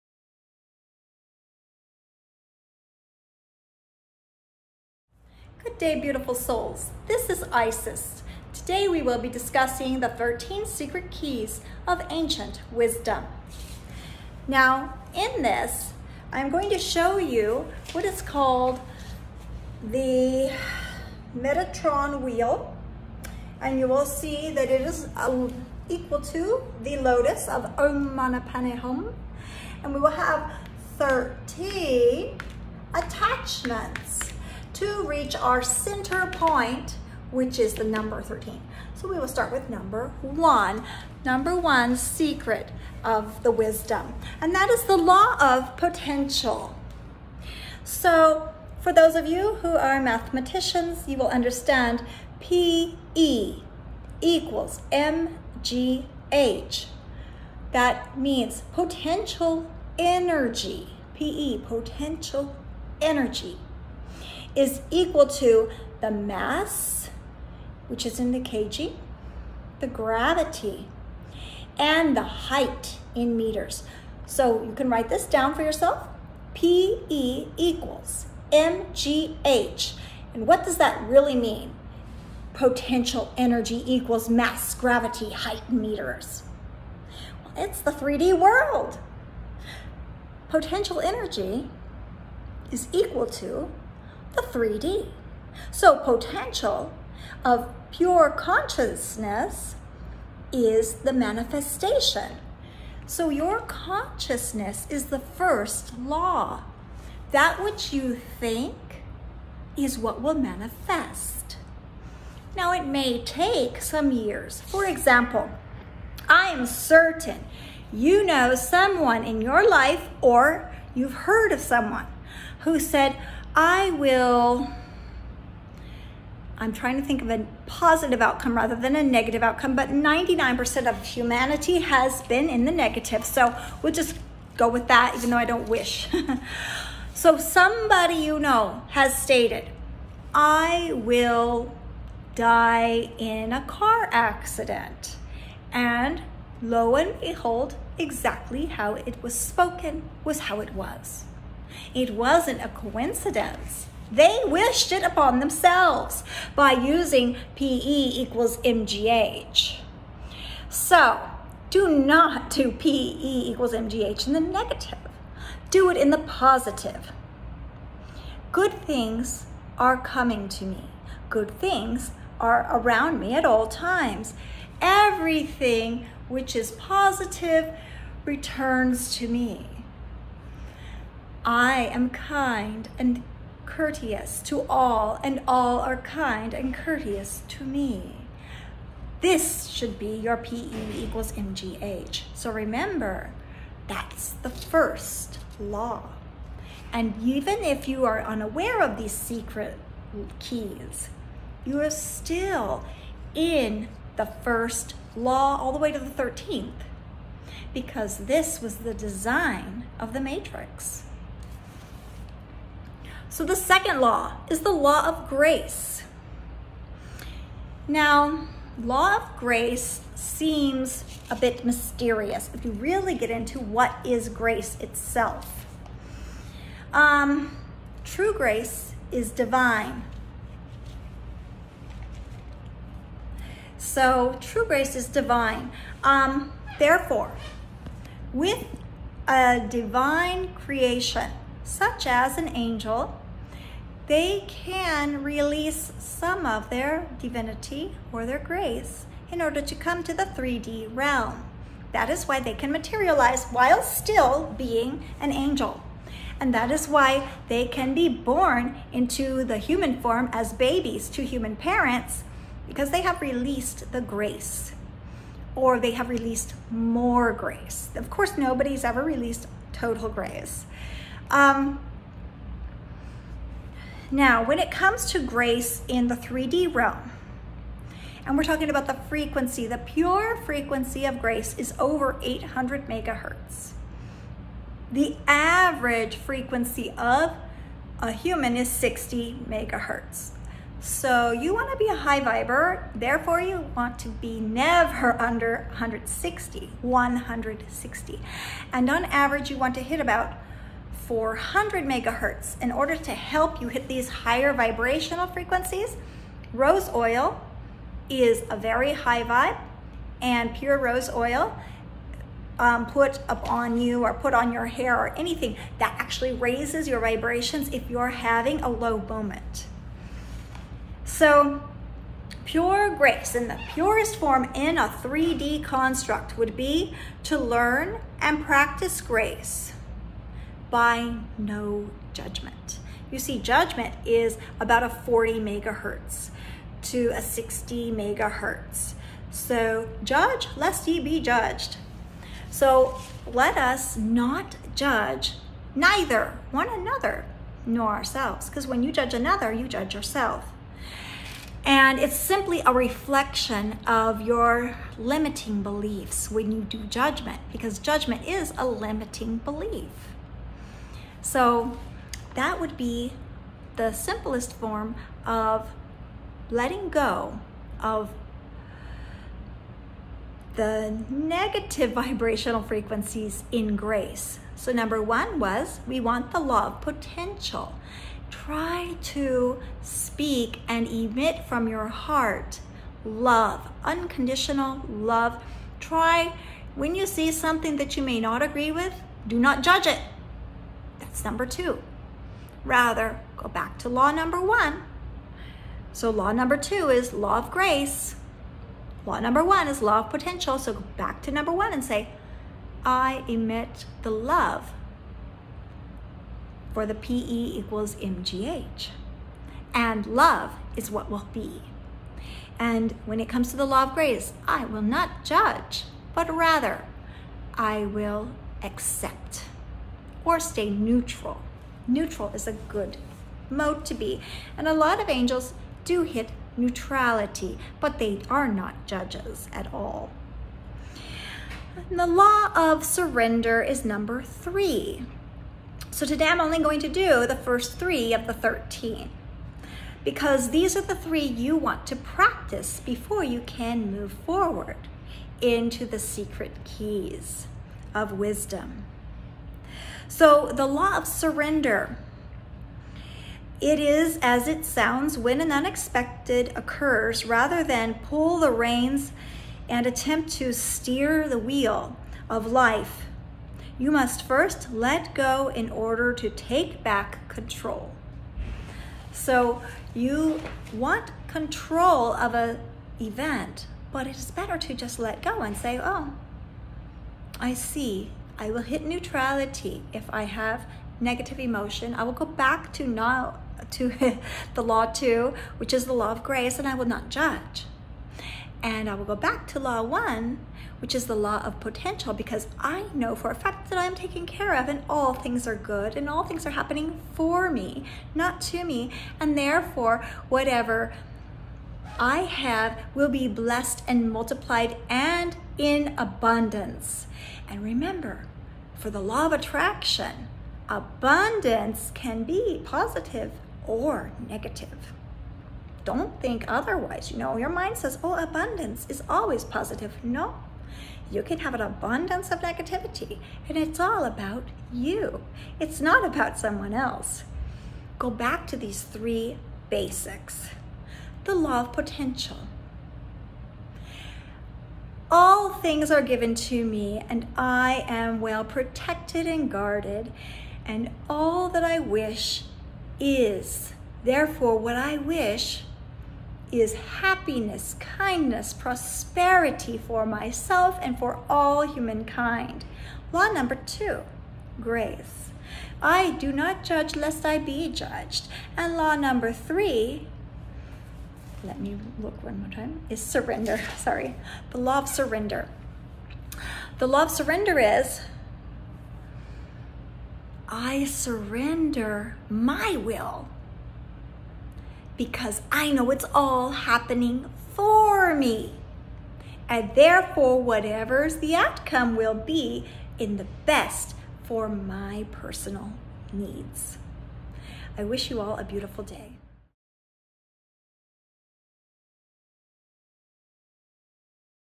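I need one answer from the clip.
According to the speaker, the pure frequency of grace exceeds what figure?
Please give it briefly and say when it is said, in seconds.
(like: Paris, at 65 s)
800 megahertz, at 281 s.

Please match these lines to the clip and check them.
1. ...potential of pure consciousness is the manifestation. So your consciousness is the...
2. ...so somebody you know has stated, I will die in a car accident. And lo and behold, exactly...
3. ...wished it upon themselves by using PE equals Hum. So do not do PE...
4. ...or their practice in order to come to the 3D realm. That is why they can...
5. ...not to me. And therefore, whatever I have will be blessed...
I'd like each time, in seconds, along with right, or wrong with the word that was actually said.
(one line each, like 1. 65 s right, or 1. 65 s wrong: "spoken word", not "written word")
1. 95 s right
2. 137 s right
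3. 154 s wrong: "MGH", not "Hum"
4. 248 s wrong: "grace", not "practice"
5. 498 s right.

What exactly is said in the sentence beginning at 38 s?
So we will start with number one.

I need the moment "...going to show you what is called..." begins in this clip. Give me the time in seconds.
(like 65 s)
16 s.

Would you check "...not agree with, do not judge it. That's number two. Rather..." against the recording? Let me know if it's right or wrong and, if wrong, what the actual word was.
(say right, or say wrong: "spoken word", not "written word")
right.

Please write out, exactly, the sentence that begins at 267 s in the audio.
Of course, nobody's ever released total grace.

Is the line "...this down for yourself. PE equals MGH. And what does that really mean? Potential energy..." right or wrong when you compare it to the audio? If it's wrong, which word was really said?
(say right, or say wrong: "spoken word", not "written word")
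right.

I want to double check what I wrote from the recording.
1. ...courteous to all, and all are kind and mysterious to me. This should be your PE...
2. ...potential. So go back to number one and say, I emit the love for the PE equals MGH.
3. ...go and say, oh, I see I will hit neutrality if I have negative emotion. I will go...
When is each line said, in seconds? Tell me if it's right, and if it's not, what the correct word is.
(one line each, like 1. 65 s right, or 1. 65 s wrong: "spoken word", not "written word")
1. 183 s wrong: "courteous", not "mysterious"
2. 400 s right
3. 475 s right.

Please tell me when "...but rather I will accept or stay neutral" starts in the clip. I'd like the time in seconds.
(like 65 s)
416 s.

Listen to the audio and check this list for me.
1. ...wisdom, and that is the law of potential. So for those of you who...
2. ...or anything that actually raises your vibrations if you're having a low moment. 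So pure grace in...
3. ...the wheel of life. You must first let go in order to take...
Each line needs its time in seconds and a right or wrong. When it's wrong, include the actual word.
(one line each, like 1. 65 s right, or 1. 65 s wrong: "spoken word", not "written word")
1. 43 s right
2. 314 s right
3. 461 s right.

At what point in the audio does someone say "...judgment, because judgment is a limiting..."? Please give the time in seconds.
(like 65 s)
356 s.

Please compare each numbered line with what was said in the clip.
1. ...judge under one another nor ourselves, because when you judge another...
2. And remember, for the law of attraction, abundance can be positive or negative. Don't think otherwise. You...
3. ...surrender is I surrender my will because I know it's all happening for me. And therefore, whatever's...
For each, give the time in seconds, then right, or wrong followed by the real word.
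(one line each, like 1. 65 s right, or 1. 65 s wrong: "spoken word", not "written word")
1. 344 s wrong: "neither", not "under"
2. 507 s right
3. 567 s right.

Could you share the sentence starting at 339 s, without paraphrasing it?
So judge, lest ye be judged.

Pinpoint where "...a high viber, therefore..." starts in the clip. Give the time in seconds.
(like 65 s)
291 s.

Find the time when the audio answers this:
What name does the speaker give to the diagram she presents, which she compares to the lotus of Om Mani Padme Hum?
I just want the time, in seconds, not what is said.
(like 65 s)
21 s.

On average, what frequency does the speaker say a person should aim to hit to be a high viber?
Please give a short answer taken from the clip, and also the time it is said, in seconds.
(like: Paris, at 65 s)
400 megahertz, at 301 s.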